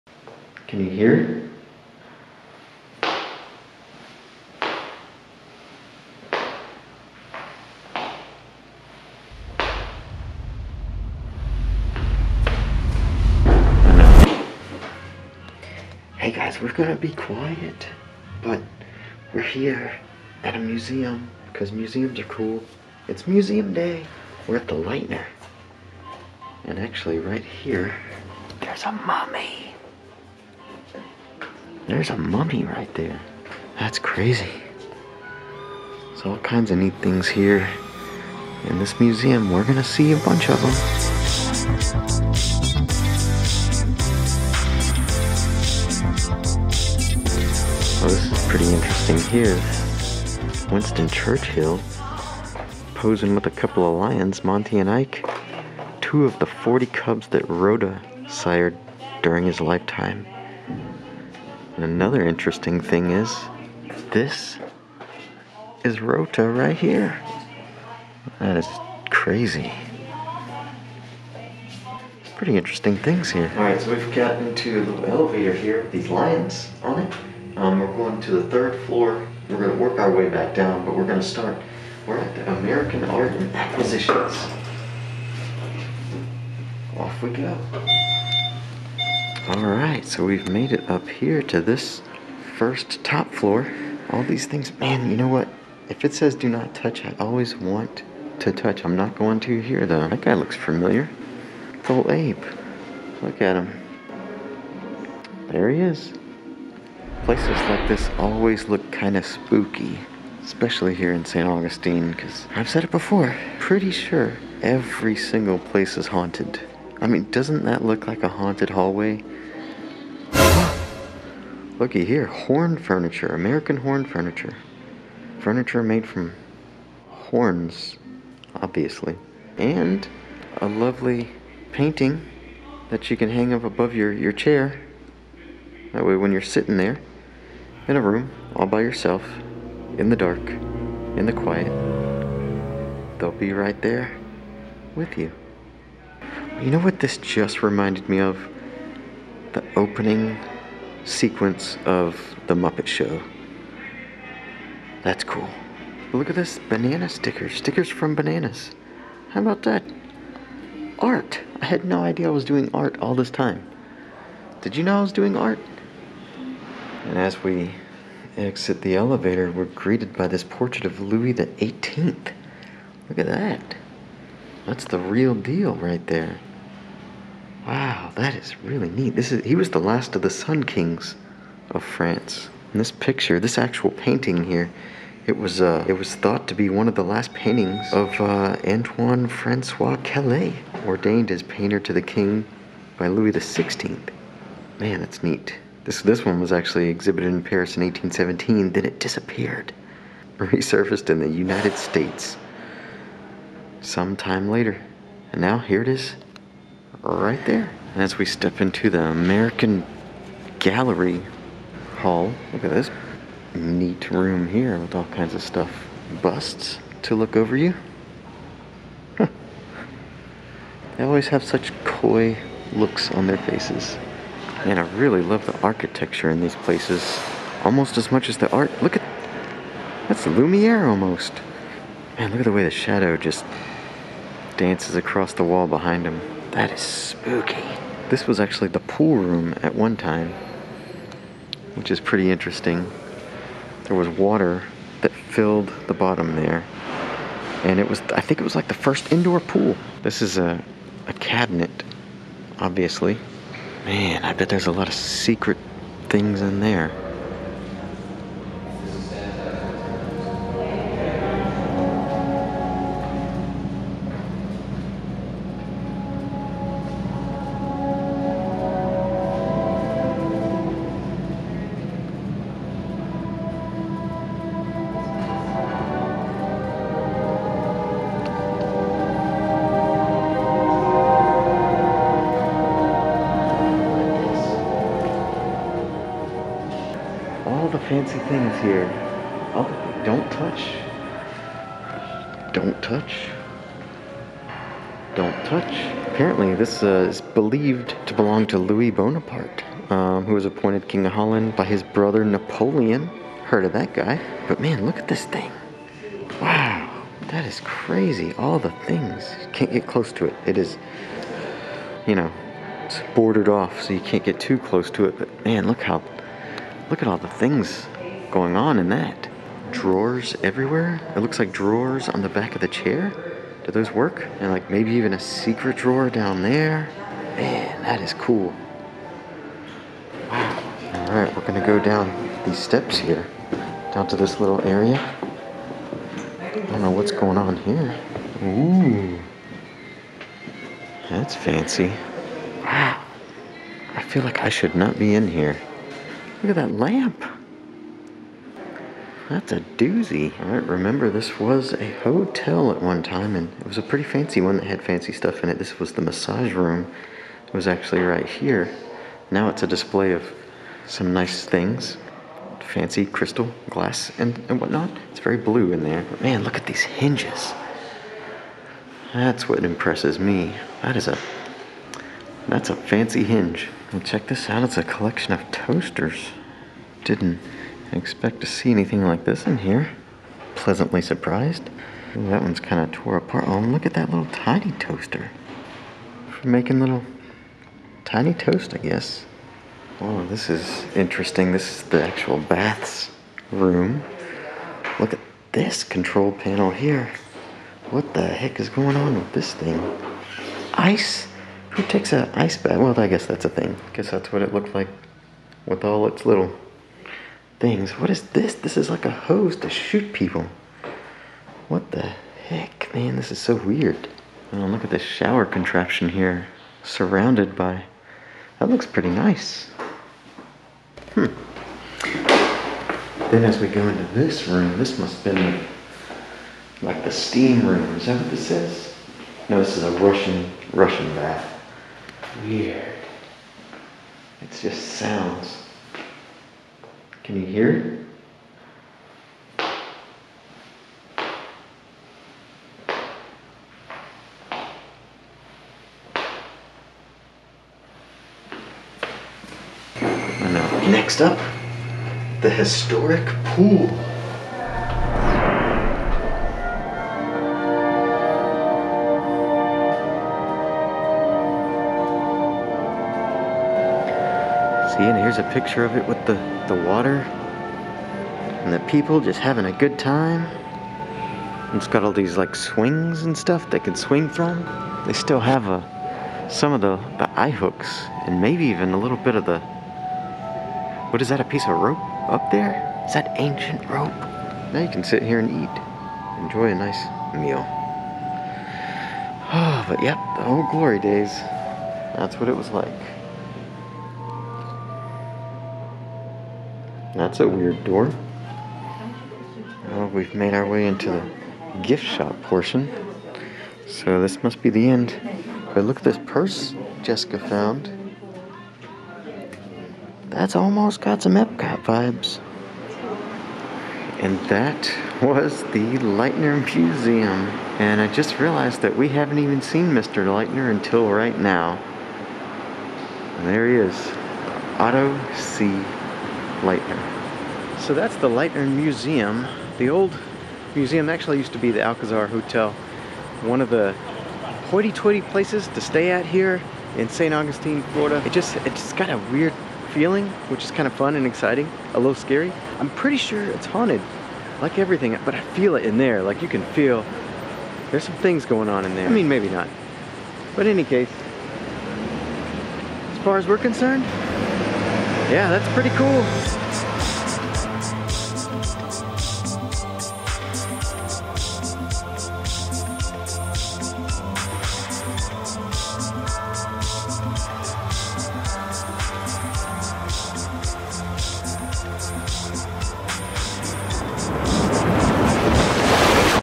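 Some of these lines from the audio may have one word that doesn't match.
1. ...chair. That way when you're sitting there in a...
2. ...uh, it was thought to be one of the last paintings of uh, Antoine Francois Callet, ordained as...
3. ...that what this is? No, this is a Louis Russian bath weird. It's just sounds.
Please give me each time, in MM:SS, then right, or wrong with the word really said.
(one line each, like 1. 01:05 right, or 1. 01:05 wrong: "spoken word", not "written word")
1. 02:14 right
2. 03:05 right
3. 07:08 wrong: "Russian", not "Louis".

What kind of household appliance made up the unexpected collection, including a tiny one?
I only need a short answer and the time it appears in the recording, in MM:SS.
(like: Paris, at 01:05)
toasters, at 06:15.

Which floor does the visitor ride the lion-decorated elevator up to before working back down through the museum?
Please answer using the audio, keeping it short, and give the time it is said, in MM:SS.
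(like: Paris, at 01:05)
third floor, at 01:18.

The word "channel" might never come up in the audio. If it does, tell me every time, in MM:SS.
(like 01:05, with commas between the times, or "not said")
not said.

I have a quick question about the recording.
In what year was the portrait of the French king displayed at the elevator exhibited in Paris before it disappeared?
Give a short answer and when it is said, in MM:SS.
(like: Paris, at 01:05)
1817, at 03:17.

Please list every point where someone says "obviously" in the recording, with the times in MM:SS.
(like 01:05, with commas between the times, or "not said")
02:08, 04:12.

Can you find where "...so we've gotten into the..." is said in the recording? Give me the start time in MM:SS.
01:13.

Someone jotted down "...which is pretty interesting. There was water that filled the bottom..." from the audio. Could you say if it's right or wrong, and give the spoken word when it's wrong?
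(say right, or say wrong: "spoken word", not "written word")
right.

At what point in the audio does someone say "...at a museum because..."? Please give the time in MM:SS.
00:20.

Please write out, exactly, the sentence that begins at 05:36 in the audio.
I don't know what's going on here.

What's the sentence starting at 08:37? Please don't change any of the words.
And I just realized that we haven't even seen Mr.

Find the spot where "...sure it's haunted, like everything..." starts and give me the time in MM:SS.
09:03.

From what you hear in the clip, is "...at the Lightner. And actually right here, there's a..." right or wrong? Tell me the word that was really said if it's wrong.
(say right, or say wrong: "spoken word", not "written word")
right.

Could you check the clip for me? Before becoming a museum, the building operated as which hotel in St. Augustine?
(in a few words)
Alcazar Hotel.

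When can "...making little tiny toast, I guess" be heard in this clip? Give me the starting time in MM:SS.
06:26.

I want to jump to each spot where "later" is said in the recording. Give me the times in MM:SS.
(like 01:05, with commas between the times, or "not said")
03:24.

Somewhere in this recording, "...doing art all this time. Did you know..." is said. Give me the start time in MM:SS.
02:42.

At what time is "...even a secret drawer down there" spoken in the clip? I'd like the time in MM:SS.
05:24.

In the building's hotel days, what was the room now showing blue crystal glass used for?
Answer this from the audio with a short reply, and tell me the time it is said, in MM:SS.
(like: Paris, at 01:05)
massage room, at 05:56.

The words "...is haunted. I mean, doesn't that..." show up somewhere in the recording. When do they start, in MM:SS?
01:55.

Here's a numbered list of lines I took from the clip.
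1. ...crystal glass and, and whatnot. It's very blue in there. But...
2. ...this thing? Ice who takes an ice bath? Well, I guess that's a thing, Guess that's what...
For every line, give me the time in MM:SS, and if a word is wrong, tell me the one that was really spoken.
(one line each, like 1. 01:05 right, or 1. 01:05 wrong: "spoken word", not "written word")
1. 06:03 right
2. 06:39 right.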